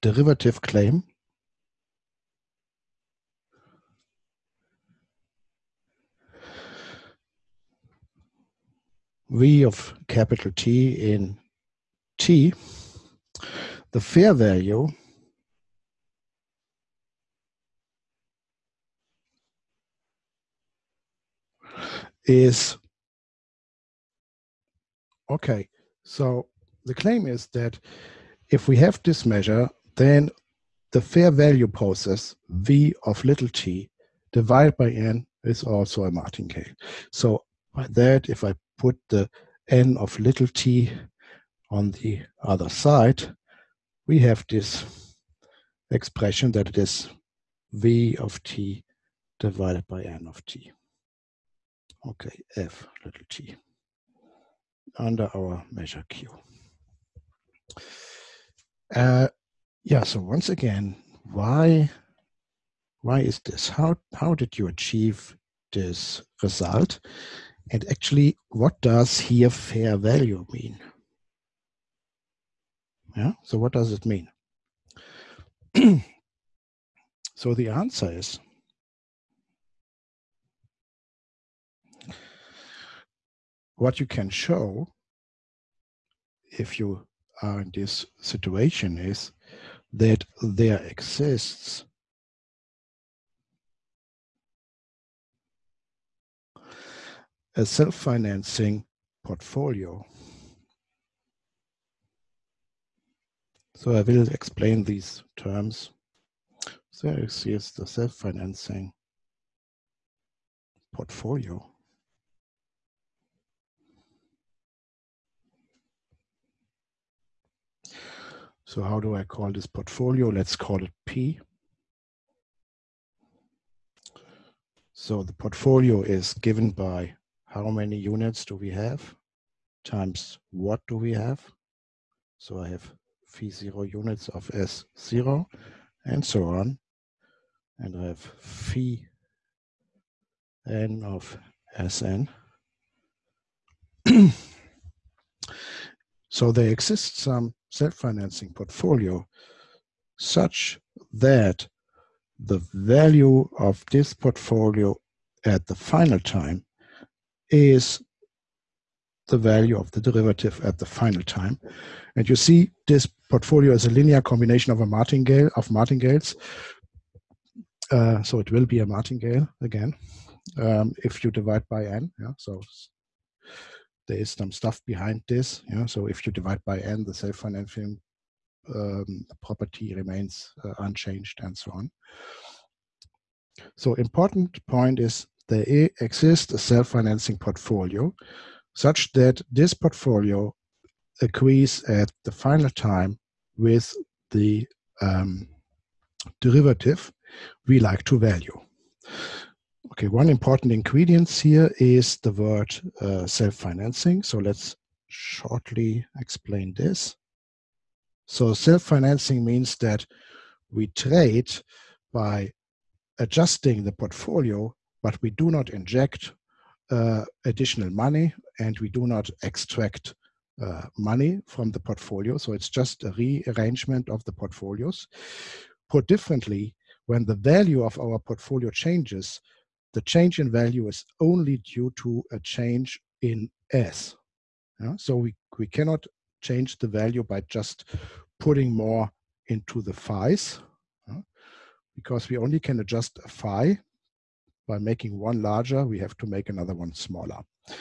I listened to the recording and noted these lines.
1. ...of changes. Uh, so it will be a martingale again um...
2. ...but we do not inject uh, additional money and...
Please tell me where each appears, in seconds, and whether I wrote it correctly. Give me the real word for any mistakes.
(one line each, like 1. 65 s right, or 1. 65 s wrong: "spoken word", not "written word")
1. 165 s wrong: "martingales", not "changes"
2. 215 s right.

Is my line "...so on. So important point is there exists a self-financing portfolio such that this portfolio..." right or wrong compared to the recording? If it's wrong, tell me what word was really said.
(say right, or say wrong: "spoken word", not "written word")
right.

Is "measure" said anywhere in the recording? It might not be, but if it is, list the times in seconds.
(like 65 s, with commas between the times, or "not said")
29 s, 55 s.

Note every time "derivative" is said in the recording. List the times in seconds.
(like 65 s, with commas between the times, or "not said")
0 s, 160 s, 196 s.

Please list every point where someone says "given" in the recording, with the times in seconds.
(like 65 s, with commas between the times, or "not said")
126 s.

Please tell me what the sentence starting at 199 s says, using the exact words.
Okay, one important ingredient here is the word uh, self-financing.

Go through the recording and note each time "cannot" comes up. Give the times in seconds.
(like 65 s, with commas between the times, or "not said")
235 s.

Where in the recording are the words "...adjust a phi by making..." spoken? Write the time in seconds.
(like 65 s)
242 s.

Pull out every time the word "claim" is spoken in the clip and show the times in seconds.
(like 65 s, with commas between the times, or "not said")
0 s, 26 s.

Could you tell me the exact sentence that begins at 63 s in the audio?
How how did you achieve this result?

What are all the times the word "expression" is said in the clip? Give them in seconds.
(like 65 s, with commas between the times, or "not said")
45 s.